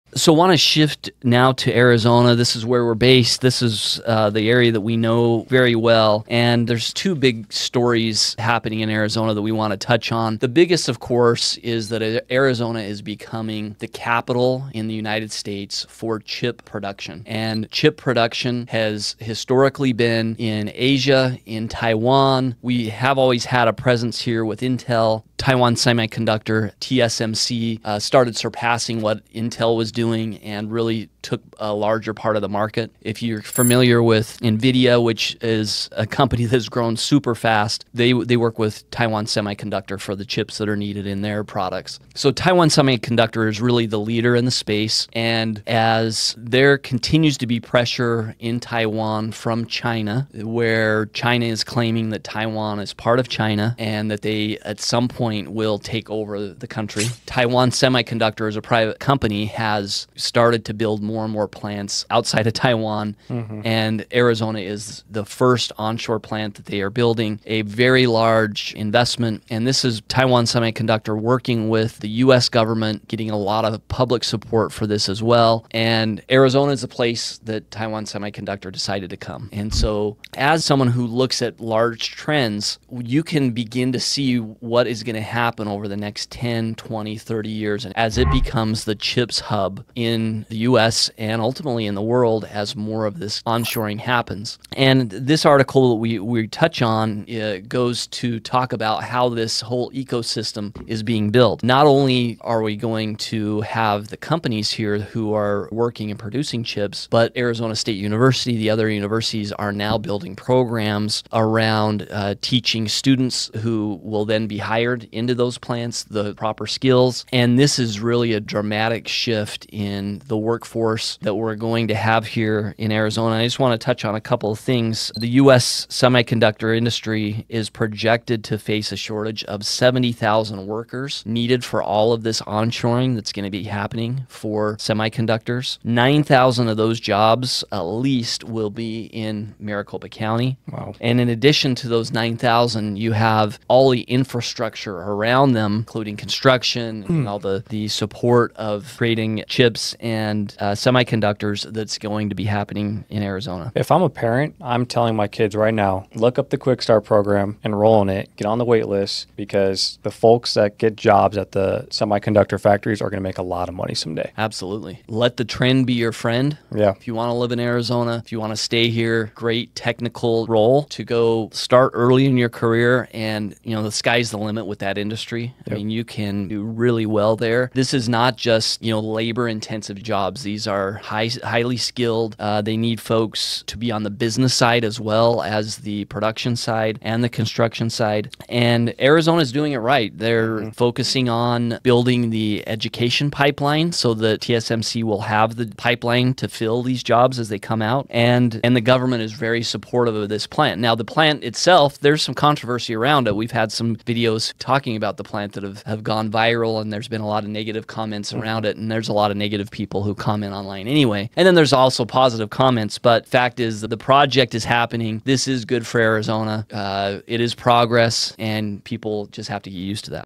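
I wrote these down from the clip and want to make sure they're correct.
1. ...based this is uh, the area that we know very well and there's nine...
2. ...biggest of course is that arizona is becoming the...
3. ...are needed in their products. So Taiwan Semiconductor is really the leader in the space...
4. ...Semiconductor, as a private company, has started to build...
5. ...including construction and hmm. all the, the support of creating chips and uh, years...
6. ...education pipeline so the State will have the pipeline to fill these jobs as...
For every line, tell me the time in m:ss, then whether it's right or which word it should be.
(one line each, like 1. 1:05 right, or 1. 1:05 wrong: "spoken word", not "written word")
1. 0:02 wrong: "two", not "nine"
2. 0:10 right
3. 0:40 right
4. 0:57 right
5. 2:25 wrong: "semiconductors", not "years"
6. 3:12 wrong: "TSMC", not "State".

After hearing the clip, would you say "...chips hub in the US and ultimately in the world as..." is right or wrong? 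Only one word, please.
right.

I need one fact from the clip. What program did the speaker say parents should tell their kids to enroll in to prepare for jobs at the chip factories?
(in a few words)
Quick Start.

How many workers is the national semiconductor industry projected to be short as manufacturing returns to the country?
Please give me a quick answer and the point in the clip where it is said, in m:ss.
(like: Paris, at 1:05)
70,000, at 2:09.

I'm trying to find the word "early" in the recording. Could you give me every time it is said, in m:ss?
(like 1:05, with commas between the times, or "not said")
2:51.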